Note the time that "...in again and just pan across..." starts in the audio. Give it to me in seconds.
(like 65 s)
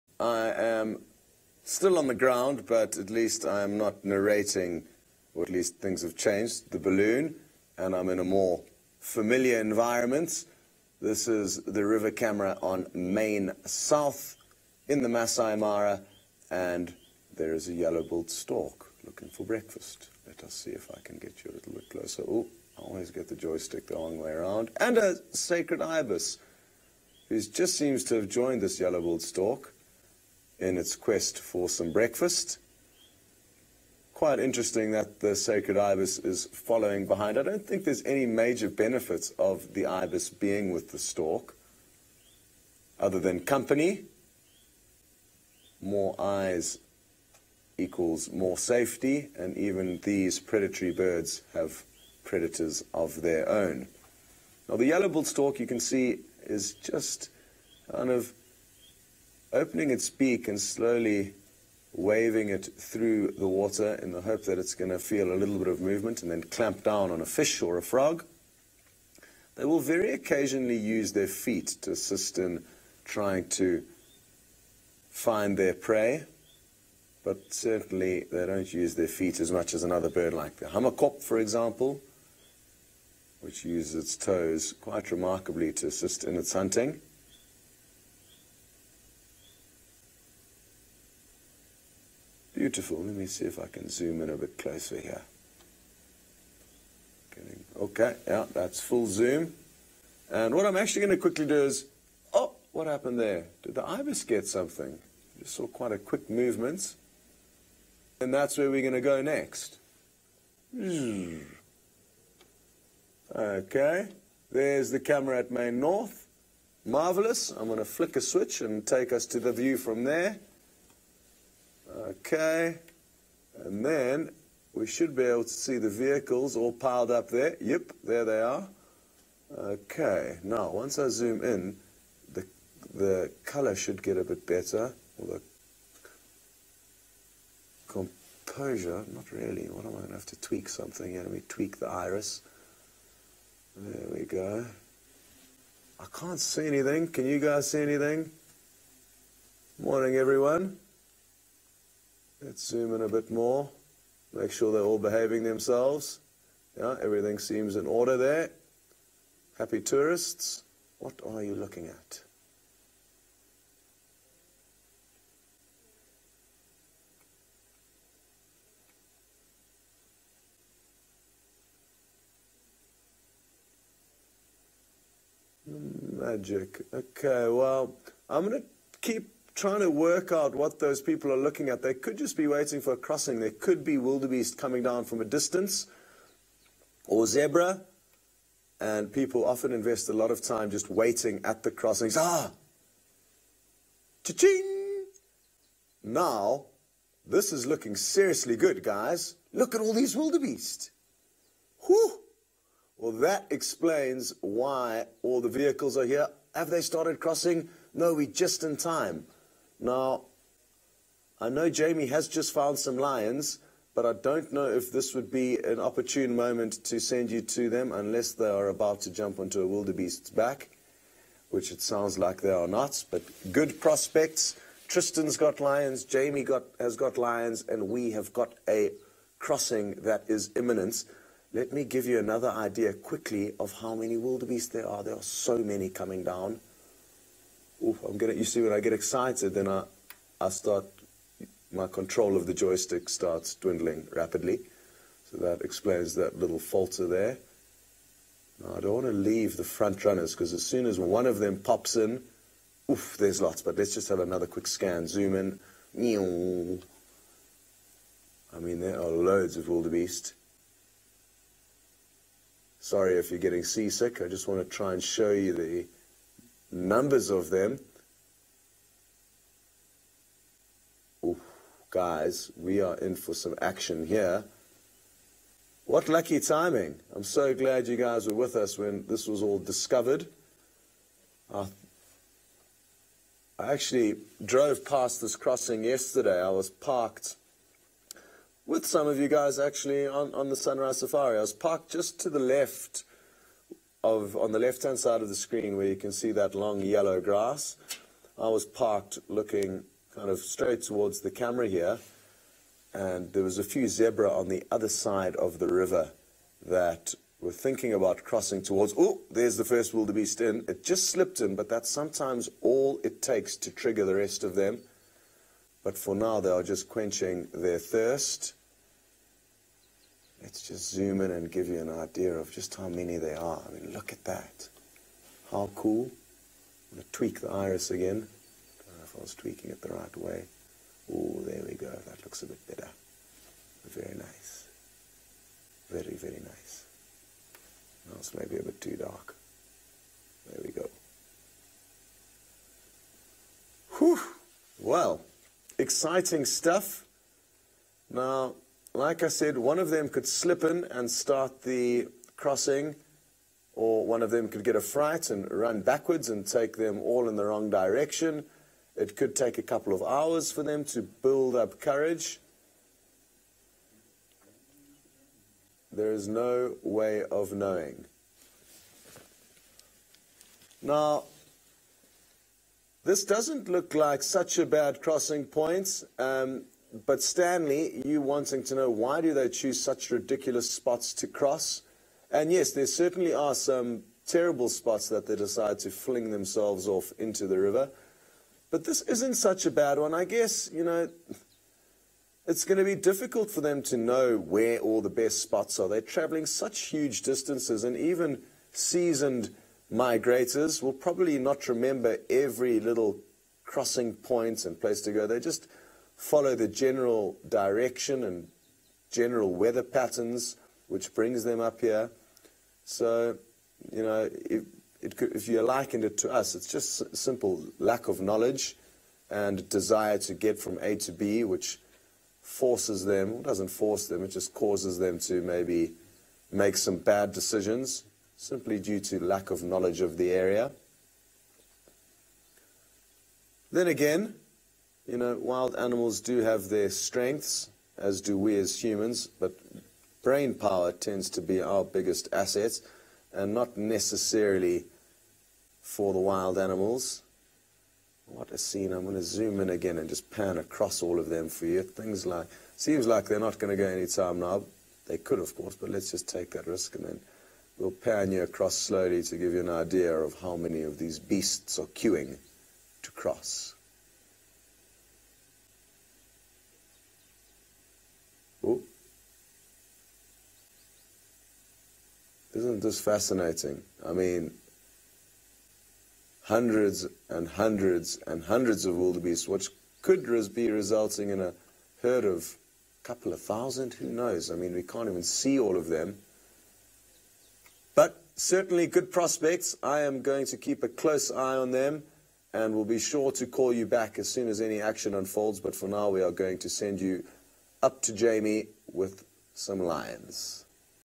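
449 s.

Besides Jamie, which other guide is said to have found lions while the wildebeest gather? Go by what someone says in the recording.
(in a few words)
Tristan.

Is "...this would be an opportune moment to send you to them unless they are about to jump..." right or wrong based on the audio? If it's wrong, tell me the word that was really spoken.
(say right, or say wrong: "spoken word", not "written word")
right.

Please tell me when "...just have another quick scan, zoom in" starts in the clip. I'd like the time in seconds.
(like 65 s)
253 s.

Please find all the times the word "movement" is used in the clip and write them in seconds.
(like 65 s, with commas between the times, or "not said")
65 s, 106 s.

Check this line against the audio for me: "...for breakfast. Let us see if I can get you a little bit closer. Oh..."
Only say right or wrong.
right.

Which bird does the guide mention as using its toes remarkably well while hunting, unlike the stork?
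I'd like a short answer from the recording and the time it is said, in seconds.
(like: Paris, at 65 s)
hamerkop, at 80 s.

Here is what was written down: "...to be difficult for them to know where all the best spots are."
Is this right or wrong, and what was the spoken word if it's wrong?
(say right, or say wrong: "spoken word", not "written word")
right.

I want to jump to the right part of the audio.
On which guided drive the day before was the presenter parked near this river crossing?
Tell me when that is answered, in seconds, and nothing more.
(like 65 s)
290 s.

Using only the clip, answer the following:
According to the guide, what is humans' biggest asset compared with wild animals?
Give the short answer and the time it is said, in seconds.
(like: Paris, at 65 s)
brain power, at 440 s.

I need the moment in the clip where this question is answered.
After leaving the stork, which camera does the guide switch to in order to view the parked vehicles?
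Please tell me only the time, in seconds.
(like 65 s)
115 s.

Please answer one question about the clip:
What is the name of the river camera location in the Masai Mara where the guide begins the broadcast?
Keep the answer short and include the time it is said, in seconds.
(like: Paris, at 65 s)
Main South, at 12 s.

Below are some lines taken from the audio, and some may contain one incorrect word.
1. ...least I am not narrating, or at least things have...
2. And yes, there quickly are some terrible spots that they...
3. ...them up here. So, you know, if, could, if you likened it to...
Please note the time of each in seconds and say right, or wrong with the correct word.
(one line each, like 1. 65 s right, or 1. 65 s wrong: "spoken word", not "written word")
1. 3 s right
2. 382 s wrong: "certainly", not "quickly"
3. 411 s right.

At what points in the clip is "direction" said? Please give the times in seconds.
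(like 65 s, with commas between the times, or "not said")
357 s, 407 s.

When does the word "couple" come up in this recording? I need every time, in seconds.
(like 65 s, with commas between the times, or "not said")
359 s, 483 s.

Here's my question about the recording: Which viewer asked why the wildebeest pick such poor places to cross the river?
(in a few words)
Stanley.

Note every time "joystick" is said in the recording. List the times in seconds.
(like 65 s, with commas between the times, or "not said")
23 s, 242 s.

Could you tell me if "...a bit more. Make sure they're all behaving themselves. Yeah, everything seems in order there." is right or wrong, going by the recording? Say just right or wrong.
right.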